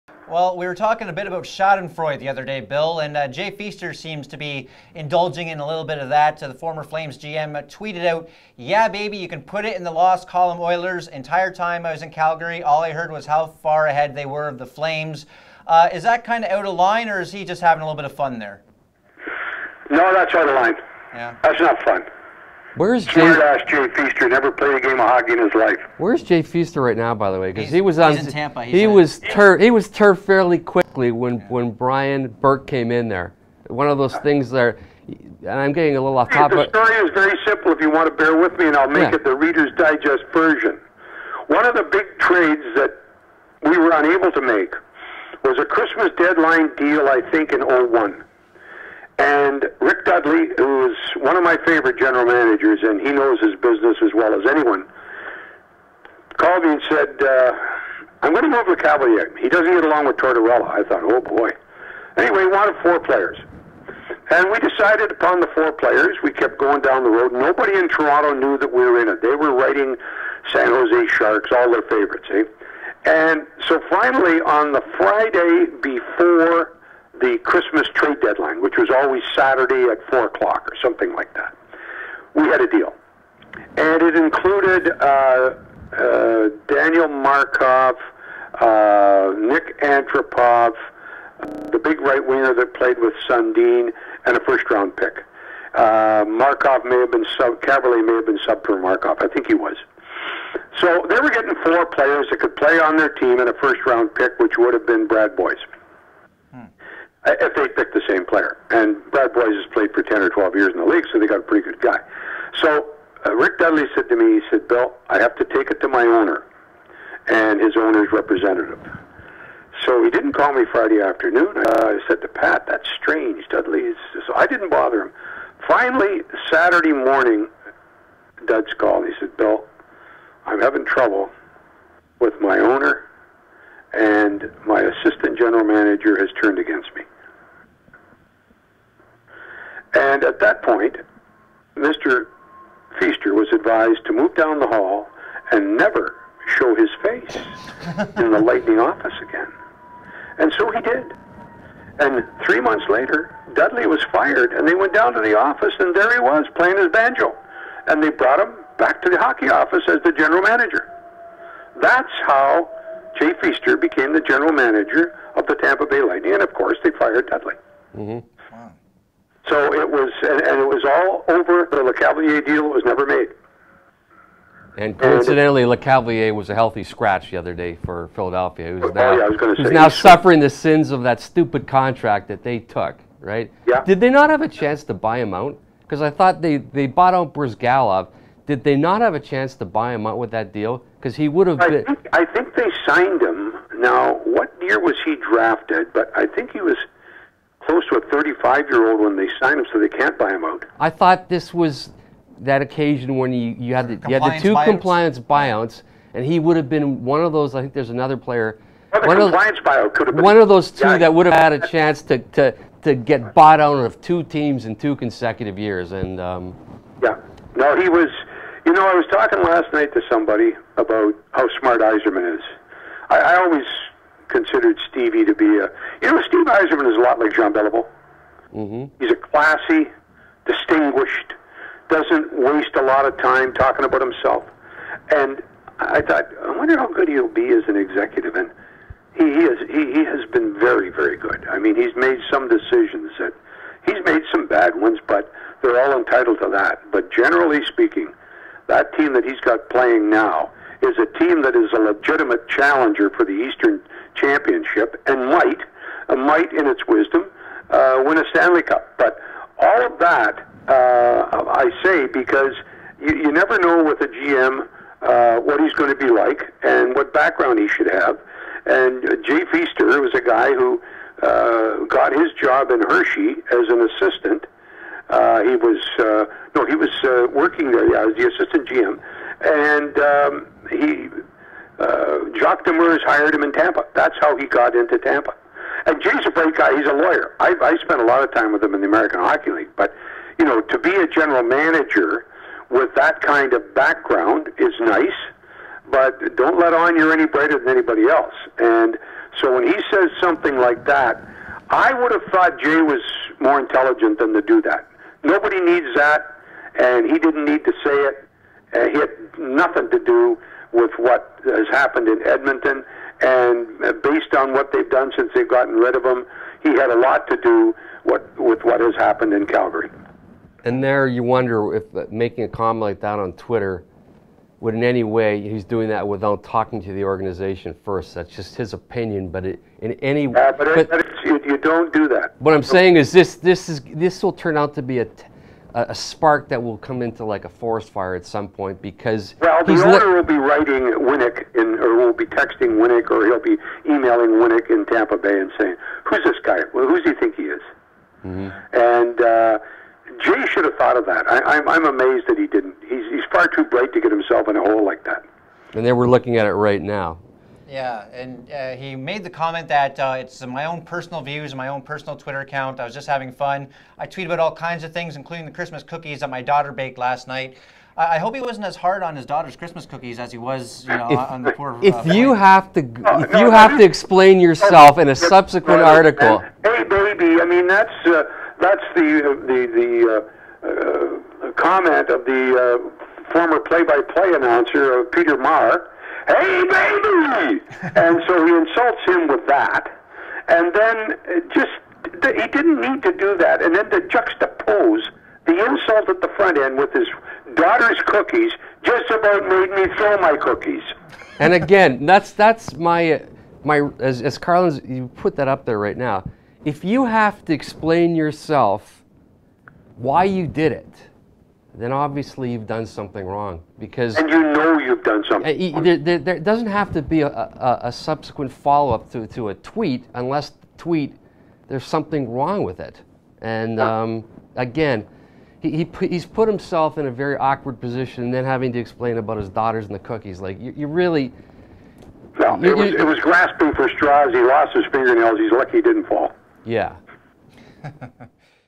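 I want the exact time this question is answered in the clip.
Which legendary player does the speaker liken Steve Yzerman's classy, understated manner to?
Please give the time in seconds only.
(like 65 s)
227 s.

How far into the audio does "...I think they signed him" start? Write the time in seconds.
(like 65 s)
192 s.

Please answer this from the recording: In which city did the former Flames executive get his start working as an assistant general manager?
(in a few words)
Hershey.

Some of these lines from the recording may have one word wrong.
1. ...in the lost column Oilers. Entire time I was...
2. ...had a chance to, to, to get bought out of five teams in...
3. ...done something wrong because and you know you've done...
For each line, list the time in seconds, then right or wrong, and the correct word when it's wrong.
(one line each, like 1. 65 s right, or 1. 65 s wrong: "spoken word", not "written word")
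1. 9 s right
2. 211 s wrong: "two", not "five"
3. 412 s right.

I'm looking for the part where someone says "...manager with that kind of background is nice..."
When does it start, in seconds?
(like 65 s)
291 s.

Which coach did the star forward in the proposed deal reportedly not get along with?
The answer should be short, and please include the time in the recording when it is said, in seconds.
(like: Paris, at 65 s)
Tortorella, at 60 s.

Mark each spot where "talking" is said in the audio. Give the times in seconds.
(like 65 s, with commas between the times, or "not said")
0 s, 219 s, 233 s, 326 s.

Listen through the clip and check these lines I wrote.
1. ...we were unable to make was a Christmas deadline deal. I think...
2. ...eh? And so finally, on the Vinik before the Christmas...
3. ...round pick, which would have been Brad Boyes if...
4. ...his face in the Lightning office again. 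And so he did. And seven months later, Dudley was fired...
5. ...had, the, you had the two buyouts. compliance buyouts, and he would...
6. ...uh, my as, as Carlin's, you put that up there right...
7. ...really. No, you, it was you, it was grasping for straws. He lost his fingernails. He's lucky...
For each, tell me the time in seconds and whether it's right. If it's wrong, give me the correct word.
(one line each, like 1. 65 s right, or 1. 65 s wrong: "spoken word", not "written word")
1. 43 s right
2. 72 s wrong: "Friday", not "Vinik"
3. 103 s right
4. 146 s wrong: "three", not "seven"
5. 203 s right
6. 403 s right
7. 430 s right.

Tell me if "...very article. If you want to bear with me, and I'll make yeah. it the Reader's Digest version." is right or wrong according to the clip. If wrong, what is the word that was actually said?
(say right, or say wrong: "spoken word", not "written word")
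wrong: "simple", not "article".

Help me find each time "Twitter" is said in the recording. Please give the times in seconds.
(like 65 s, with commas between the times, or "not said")
323 s, 362 s.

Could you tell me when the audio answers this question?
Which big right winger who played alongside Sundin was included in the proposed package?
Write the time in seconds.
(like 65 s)
89 s.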